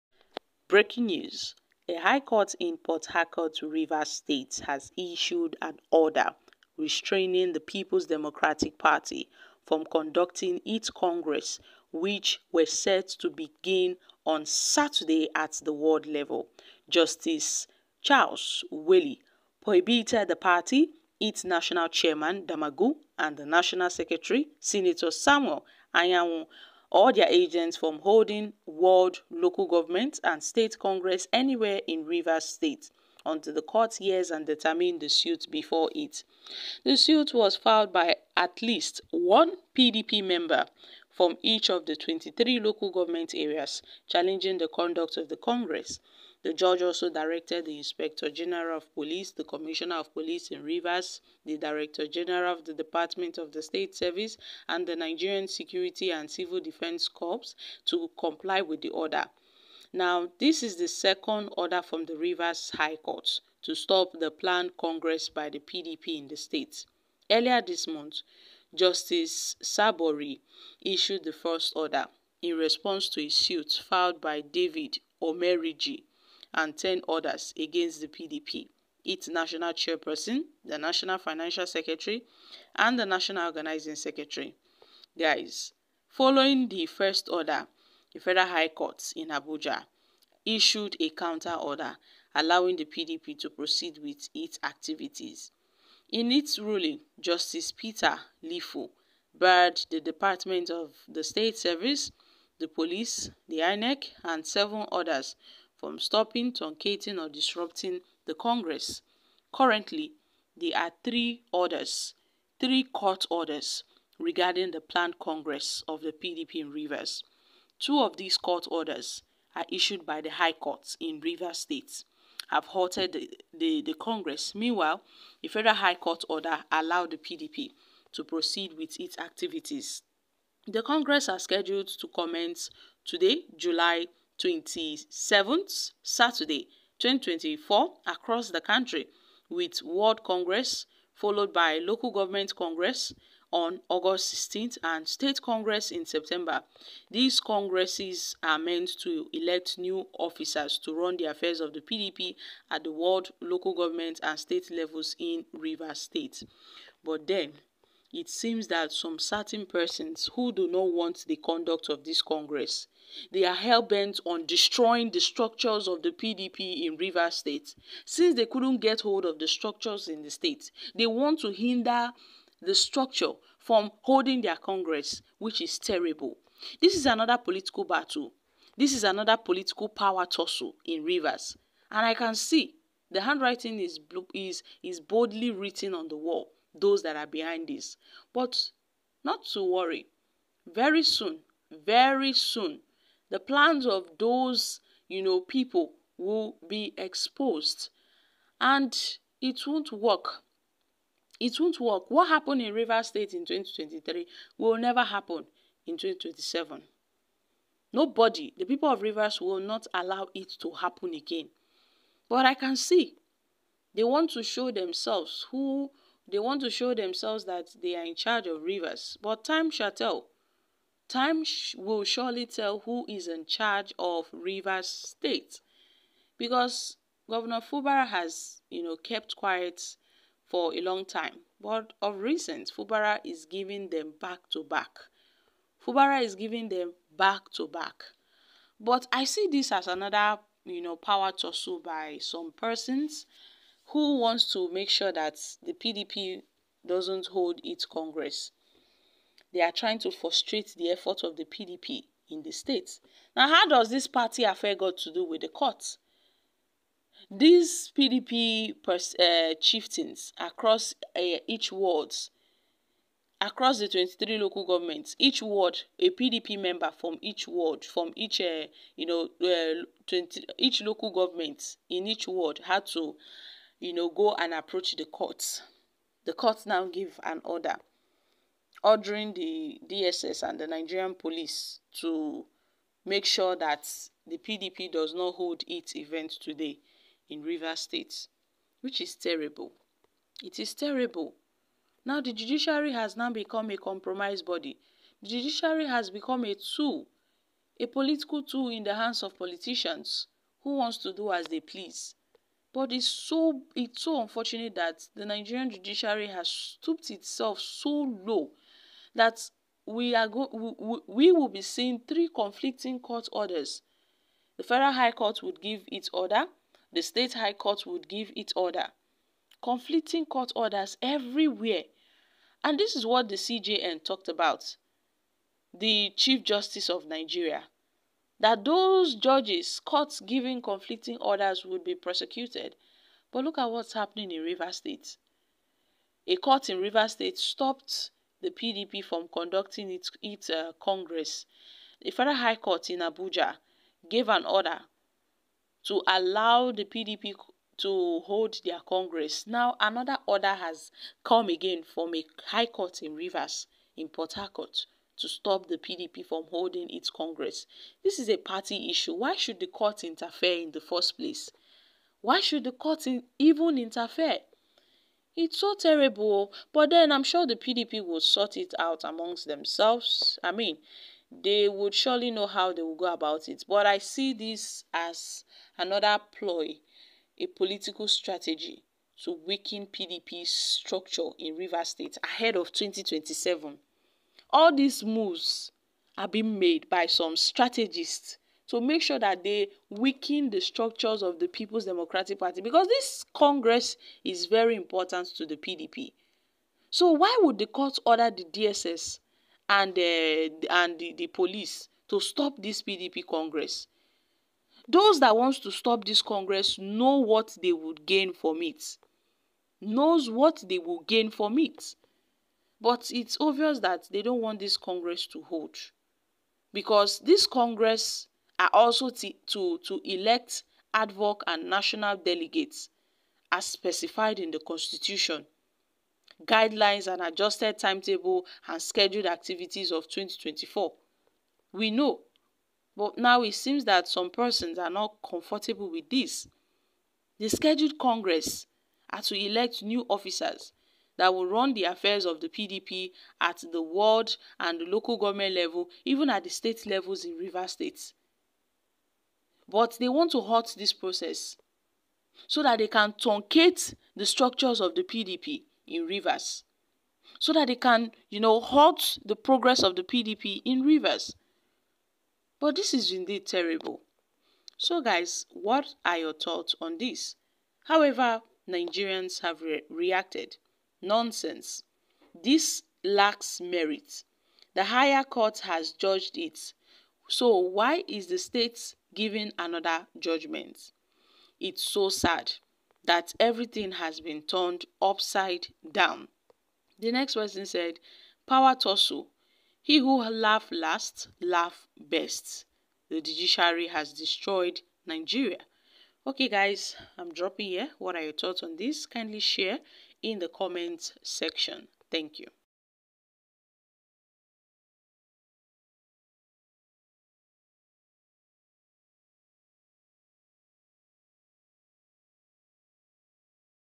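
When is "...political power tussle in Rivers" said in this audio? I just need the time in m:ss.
2:59.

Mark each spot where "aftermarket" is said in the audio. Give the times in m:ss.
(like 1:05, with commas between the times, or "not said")
not said.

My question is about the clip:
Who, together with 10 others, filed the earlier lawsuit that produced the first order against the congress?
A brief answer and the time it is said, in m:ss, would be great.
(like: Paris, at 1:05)
David Omeriji, at 1:14.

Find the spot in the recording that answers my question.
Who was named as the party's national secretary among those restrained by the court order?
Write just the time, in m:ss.
0:25.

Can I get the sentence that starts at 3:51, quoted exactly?
But of recent, Fubara is giving them back to back.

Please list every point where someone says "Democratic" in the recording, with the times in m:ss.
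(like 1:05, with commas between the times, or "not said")
0:08, 6:31.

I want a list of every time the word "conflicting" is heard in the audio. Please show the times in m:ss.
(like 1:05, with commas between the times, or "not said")
5:12, 5:19, 5:30.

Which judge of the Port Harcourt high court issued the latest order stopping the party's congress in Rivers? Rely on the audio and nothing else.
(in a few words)
Charles Willie.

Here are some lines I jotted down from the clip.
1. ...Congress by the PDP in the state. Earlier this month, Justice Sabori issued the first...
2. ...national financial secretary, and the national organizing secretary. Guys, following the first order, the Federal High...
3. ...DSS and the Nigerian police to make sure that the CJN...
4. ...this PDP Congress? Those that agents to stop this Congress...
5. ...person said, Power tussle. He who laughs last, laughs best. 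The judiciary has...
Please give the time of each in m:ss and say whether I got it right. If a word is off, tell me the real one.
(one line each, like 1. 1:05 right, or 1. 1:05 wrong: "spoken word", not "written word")
1. 1:04 right
2. 1:20 right
3. 4:39 wrong: "PDP", not "CJN"
4. 6:42 wrong: "wants", not "agents"
5. 8:07 right.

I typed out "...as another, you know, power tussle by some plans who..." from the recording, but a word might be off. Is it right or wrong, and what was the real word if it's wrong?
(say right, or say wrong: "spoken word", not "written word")
wrong: "persons", not "plans".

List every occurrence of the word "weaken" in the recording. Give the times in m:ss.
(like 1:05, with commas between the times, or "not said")
6:19, 6:29.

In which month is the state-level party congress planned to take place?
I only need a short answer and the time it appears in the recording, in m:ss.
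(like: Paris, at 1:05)
September, at 2:26.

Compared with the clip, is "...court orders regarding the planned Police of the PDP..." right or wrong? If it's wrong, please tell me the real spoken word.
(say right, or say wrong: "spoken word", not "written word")
wrong: "Congress", not "Police".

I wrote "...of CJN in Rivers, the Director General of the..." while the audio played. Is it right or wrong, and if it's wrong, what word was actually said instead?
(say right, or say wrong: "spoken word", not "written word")
wrong: "Police", not "CJN".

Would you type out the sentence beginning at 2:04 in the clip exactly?
Meanwhile, a federal High Court order allowed the PDP to proceed with its activities.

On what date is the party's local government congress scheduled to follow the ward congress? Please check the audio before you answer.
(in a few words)
August 16th.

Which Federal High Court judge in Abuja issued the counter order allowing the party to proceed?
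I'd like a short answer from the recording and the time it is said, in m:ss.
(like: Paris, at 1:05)
Peter Lifu, at 1:37.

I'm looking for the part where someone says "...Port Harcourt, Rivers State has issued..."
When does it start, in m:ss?
0:02.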